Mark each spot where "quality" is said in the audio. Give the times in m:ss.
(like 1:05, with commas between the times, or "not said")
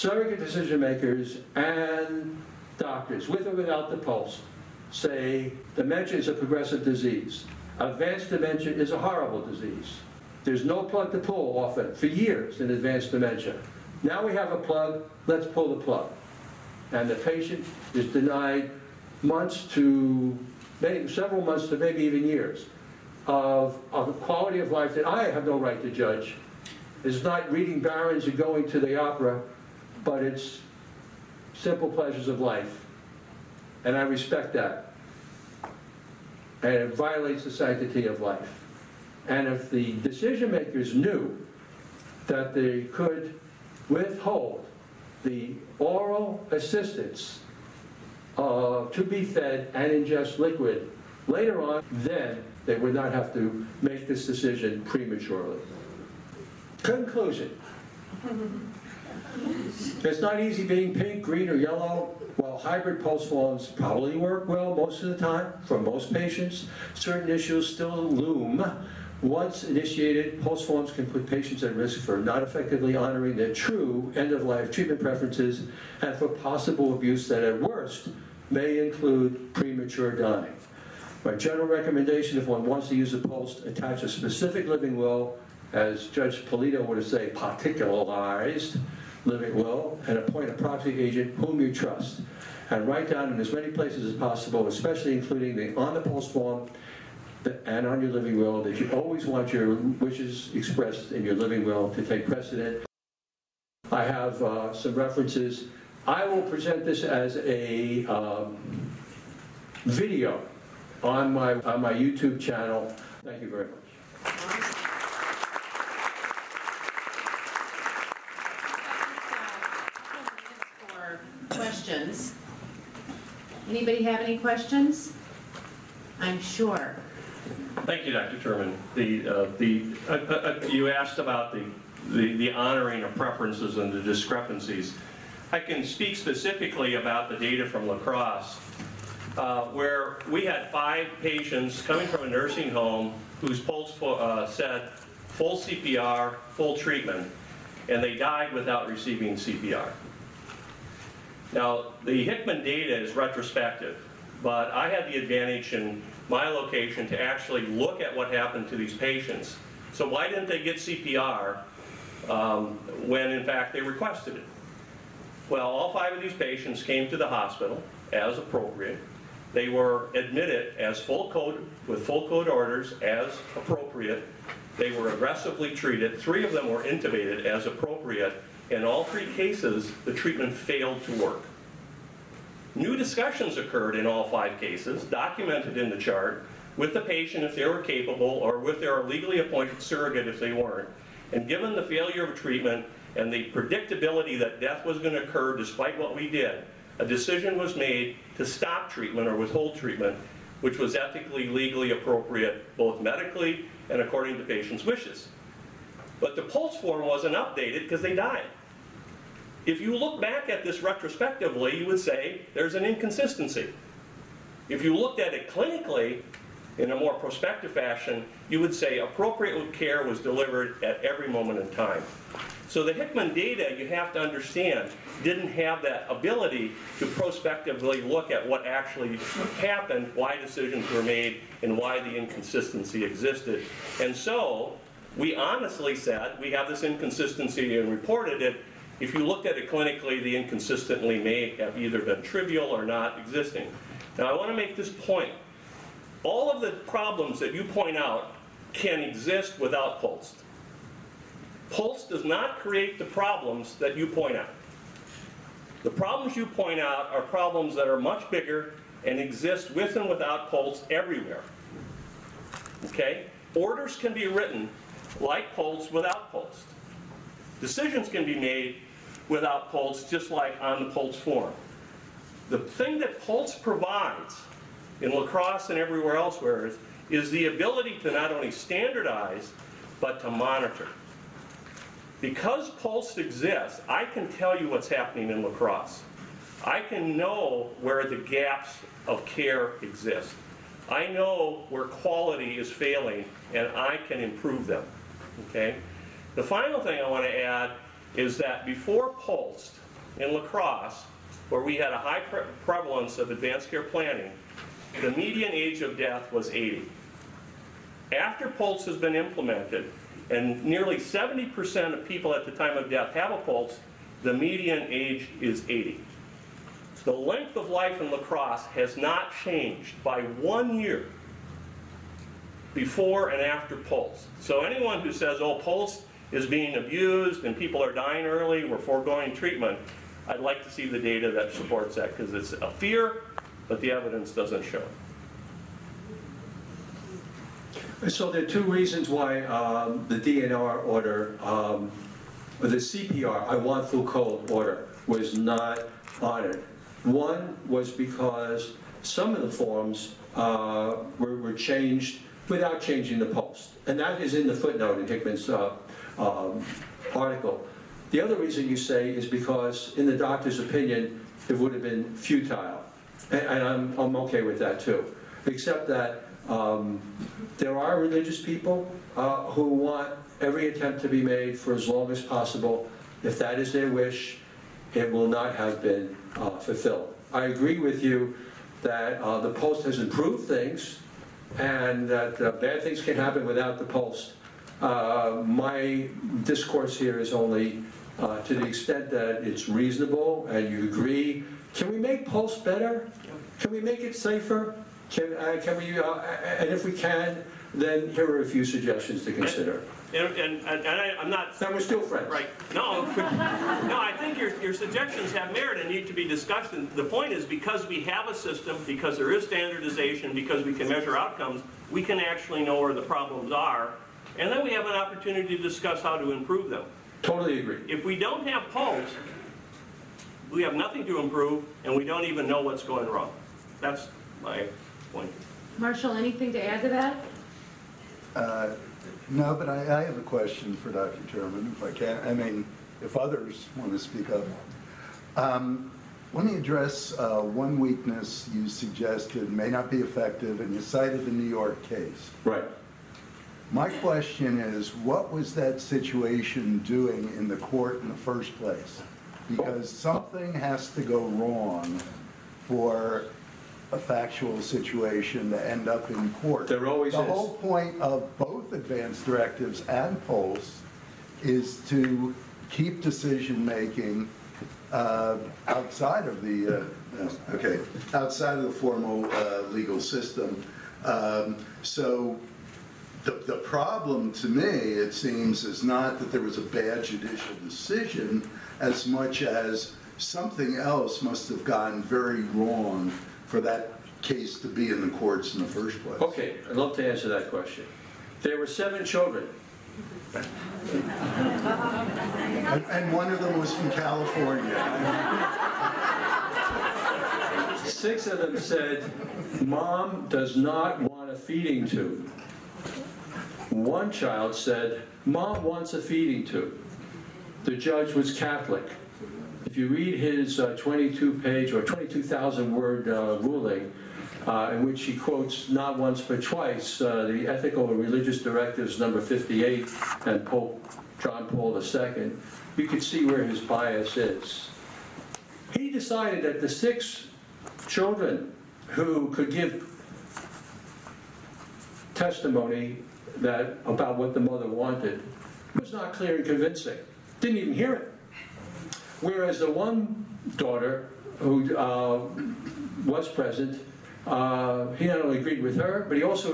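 0:24, 4:51.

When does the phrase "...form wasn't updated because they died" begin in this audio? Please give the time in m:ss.
3:26.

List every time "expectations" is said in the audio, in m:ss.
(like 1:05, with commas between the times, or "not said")
not said.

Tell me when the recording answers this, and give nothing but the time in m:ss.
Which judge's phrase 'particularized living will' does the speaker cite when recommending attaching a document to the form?
1:26.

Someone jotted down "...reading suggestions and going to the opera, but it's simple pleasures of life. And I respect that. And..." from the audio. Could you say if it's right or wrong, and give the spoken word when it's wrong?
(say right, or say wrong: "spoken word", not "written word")
wrong: "barons", not "suggestions".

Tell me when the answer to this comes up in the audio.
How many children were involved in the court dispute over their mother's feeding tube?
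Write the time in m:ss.
8:08.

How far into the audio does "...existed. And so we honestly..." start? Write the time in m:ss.
3:53.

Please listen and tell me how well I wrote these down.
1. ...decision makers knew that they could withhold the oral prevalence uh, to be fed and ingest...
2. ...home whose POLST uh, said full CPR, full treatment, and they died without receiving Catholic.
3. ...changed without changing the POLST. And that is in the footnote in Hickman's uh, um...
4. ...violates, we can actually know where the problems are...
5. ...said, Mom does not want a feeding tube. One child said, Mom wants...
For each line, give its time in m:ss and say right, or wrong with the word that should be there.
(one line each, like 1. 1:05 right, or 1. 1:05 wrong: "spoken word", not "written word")
1. 0:39 wrong: "assistance", not "prevalence"
2. 2:22 wrong: "CPR", not "Catholic"
3. 5:51 right
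4. 6:51 wrong: "outcomes", not "violates"
5. 8:18 right.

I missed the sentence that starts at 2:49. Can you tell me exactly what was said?
They were admitted as full code, with full code orders as appropriate.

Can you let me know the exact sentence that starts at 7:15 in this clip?
Um, let me address uh, one weakness you suggested may not be effective, and you cited the New York case.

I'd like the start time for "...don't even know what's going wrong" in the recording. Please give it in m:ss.
7:02.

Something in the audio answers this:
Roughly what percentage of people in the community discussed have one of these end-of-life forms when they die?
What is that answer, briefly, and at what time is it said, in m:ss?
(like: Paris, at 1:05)
70%, at 5:10.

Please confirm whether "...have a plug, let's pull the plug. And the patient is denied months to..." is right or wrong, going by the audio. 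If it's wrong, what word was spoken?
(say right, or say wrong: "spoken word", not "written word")
right.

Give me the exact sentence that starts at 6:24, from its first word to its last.
Uh, my discourse here is only uh, to the extent that it's reasonable and you agree.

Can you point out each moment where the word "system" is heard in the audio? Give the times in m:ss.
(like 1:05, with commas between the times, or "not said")
6:48, 7:50.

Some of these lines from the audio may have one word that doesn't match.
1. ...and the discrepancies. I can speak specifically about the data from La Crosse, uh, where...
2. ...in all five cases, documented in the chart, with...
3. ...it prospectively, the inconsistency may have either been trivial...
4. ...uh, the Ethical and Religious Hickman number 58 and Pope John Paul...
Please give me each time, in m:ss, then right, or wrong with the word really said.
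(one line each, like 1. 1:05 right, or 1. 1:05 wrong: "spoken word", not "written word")
1. 2:13 right
2. 3:03 right
3. 3:59 wrong: "clinically", not "prospectively"
4. 8:37 wrong: "Directives", not "Hickman".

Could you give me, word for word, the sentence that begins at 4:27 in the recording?
Decisions can be made without POLST, just like on the POLST form.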